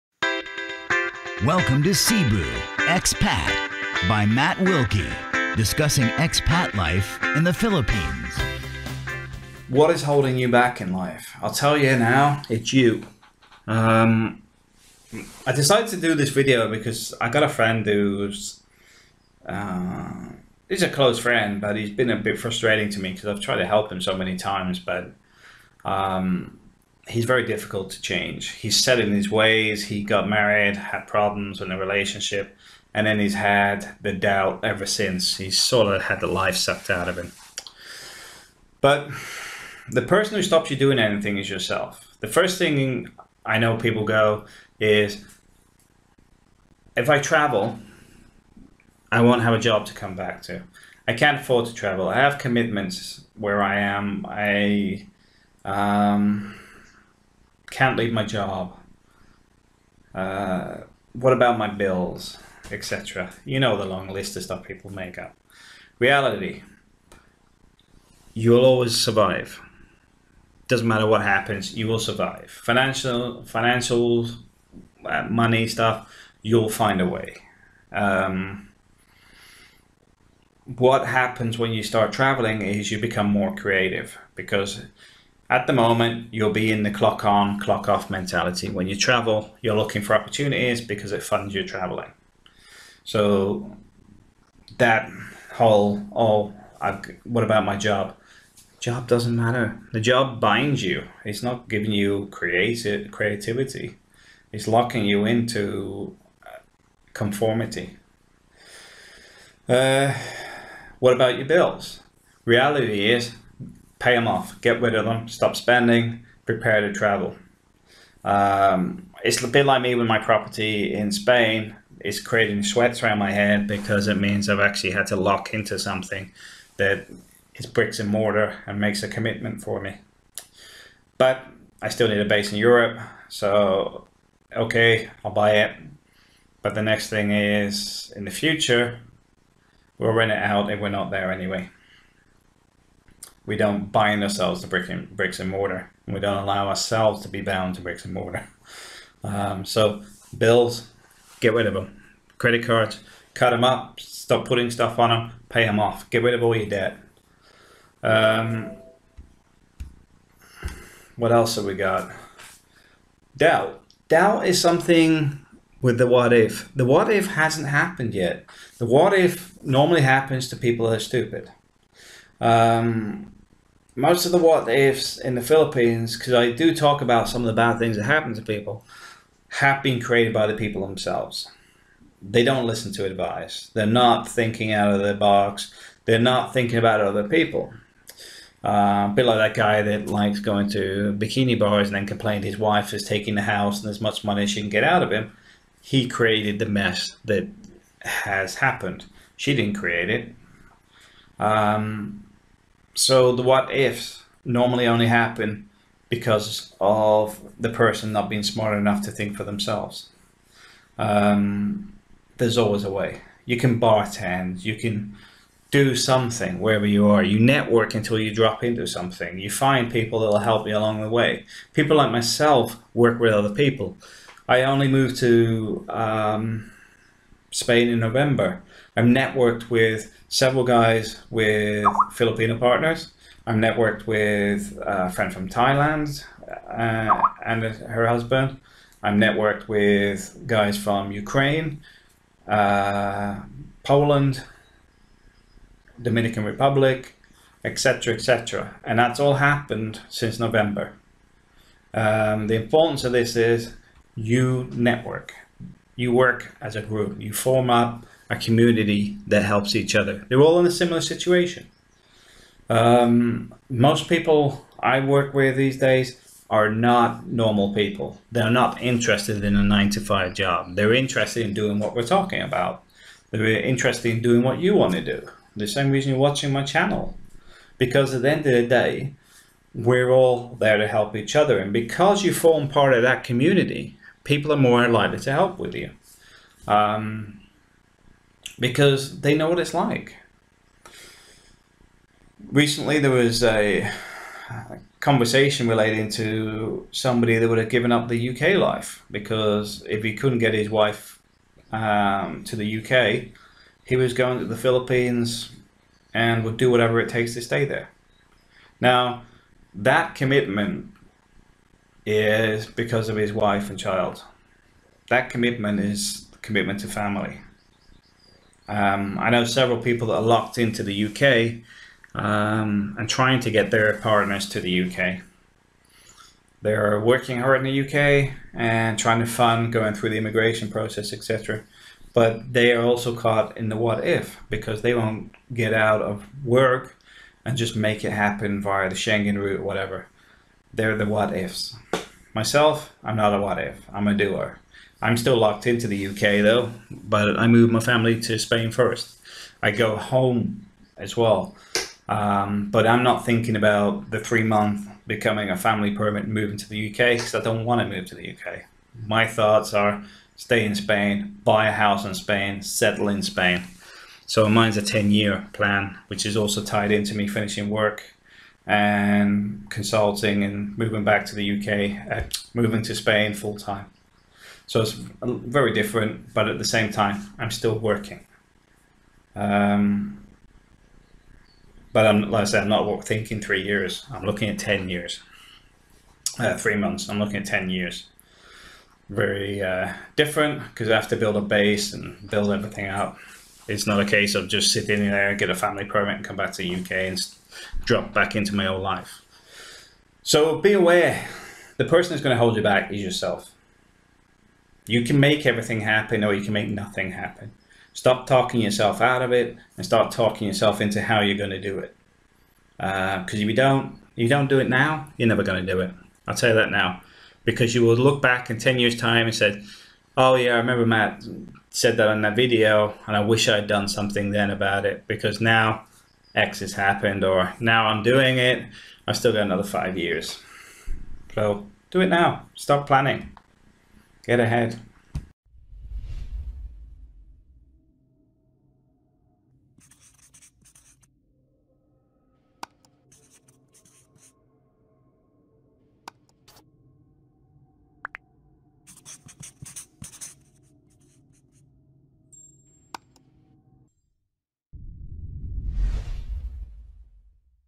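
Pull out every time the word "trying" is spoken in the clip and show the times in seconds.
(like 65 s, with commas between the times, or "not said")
323 s, 328 s.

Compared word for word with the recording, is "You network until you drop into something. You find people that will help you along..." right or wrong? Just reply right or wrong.
right.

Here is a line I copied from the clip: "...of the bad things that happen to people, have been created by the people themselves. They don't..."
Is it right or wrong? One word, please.
right.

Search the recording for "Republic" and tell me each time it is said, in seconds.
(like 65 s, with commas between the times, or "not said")
246 s.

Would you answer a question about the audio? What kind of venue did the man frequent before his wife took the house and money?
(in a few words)
Bikini bars.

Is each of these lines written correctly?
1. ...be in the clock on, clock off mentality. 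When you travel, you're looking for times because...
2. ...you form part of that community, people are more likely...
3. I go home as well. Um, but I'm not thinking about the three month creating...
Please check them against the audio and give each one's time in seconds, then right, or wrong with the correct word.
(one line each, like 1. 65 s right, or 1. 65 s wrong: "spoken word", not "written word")
1. 86 s wrong: "opportunities", not "times"
2. 282 s right
3. 349 s wrong: "becoming", not "creating".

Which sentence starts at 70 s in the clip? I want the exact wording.
Doesn't matter what happens, you will survive.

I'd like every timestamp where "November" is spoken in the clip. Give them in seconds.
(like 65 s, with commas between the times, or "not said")
228 s, 250 s.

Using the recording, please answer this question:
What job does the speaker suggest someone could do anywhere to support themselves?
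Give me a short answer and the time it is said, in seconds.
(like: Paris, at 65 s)
Bartend, at 213 s.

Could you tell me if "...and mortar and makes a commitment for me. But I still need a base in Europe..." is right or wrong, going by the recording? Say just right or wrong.
right.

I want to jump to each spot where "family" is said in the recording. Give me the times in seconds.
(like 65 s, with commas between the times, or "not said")
316 s, 347 s, 355 s, 395 s.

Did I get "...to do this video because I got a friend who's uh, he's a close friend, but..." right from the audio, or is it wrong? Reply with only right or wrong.
right.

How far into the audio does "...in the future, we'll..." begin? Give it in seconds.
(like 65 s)
138 s.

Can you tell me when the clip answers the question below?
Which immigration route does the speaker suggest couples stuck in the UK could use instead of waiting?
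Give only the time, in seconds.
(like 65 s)
338 s.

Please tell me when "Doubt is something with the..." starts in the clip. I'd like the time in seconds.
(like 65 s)
164 s.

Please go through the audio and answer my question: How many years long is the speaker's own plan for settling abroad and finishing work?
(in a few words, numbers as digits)
10.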